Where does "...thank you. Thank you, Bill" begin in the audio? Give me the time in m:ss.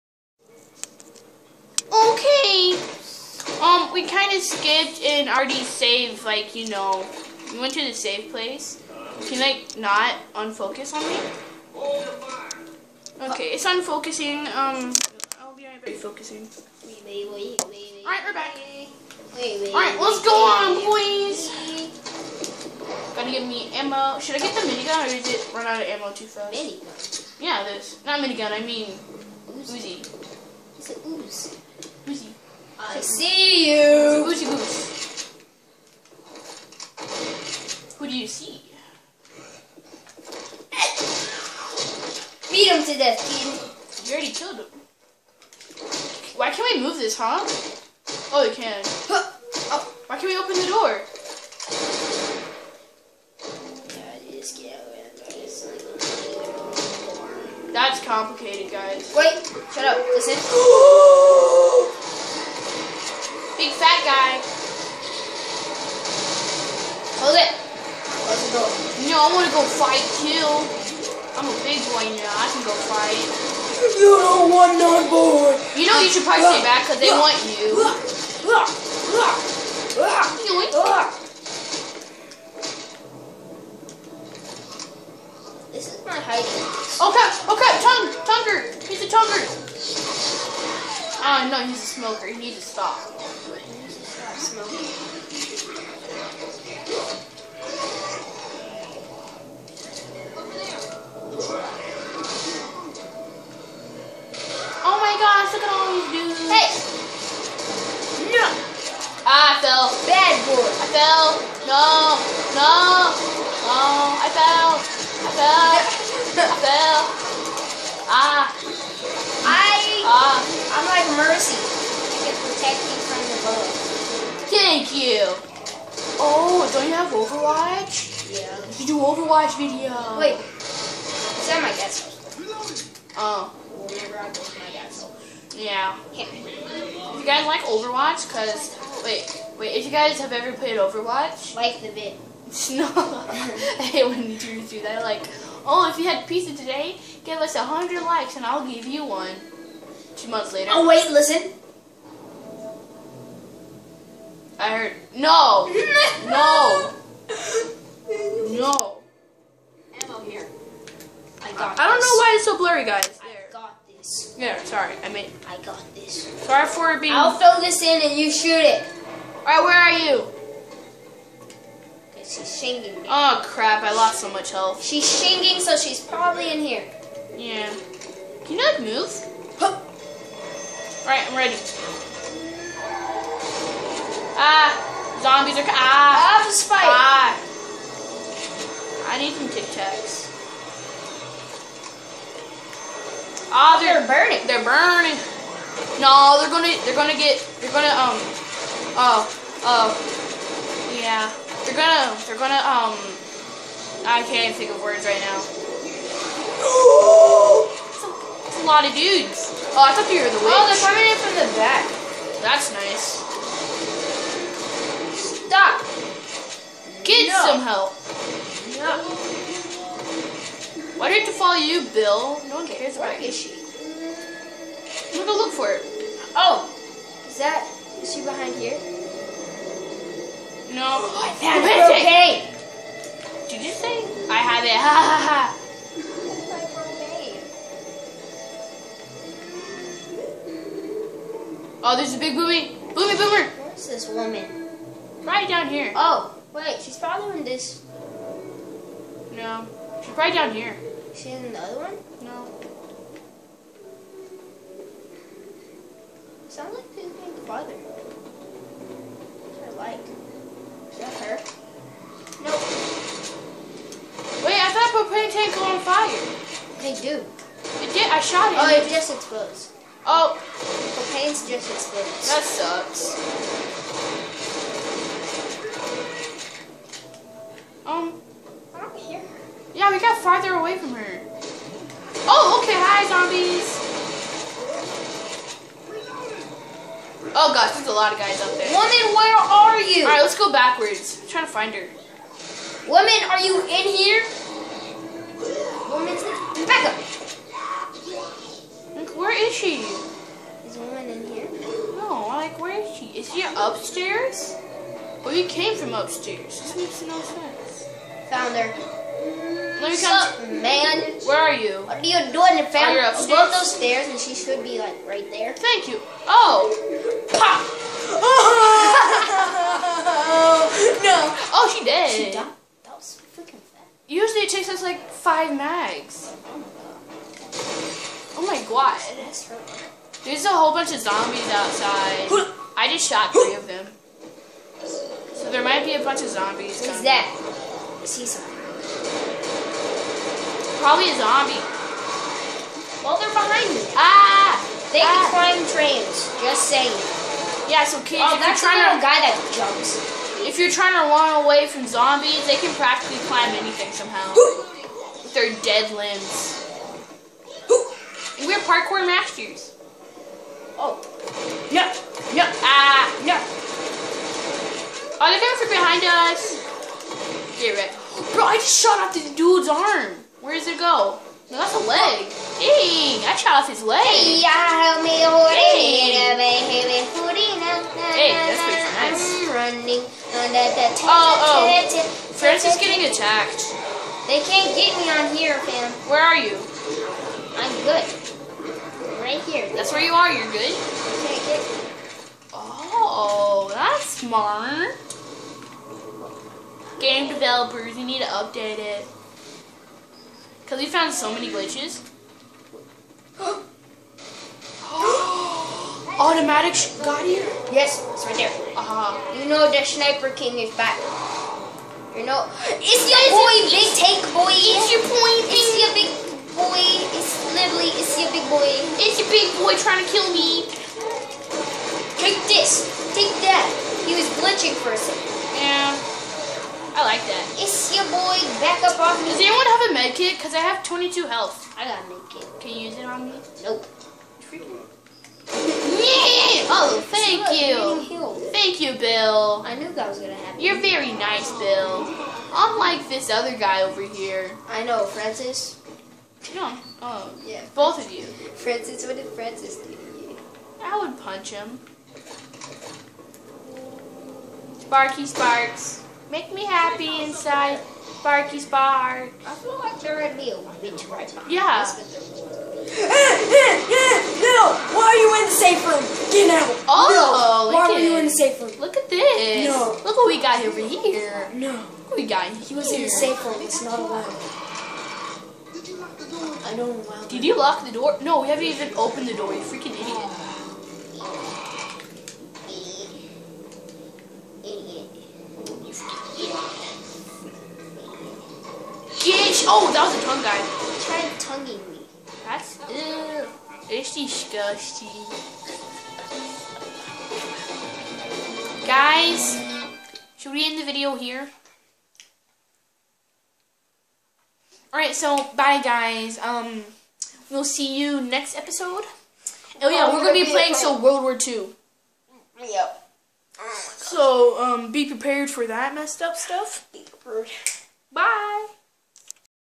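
7:17.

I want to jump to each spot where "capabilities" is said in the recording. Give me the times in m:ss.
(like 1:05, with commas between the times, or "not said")
not said.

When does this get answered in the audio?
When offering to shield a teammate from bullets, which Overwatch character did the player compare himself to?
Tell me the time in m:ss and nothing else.
2:00.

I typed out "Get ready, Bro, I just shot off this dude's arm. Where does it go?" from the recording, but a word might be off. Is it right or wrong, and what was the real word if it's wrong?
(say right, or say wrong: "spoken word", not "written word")
right.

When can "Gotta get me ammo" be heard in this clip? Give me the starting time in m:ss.
0:23.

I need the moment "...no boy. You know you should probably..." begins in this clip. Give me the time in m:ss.
1:14.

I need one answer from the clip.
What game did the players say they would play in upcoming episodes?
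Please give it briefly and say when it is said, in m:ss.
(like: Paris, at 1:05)
World War Two, at 8:30.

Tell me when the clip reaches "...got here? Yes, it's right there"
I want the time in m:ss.
6:47.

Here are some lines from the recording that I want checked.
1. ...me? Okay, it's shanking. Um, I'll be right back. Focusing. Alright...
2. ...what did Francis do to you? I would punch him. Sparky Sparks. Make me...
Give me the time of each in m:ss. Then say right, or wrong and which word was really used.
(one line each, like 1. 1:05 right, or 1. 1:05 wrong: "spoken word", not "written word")
1. 0:11 wrong: "unfocusing", not "shanking"
2. 7:29 right.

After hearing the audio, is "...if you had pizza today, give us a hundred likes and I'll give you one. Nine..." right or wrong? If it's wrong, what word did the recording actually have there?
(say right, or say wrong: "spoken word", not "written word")
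wrong: "Two", not "Nine".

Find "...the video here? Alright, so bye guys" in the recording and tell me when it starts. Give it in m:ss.
8:20.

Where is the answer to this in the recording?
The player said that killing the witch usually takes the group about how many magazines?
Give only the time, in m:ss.
5:25.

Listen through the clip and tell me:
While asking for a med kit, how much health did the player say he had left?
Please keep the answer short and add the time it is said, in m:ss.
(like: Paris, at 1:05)
22, at 7:10.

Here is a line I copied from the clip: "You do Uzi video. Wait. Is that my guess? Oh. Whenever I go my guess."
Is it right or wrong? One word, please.
wrong.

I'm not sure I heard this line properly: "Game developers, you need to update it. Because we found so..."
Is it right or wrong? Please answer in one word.
right.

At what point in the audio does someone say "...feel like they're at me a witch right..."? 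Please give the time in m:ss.
7:39.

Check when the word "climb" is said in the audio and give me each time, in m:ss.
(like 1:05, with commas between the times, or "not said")
5:45, 5:53.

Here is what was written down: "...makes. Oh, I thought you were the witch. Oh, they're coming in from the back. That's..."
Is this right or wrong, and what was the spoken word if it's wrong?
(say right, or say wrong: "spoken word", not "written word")
wrong: "dudes", not "makes".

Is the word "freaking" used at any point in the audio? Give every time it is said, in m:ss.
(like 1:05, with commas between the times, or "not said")
7:14, 7:59.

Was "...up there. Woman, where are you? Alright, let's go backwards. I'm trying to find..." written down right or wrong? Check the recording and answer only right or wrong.
right.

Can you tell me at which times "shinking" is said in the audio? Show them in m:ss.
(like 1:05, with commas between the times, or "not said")
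2:52.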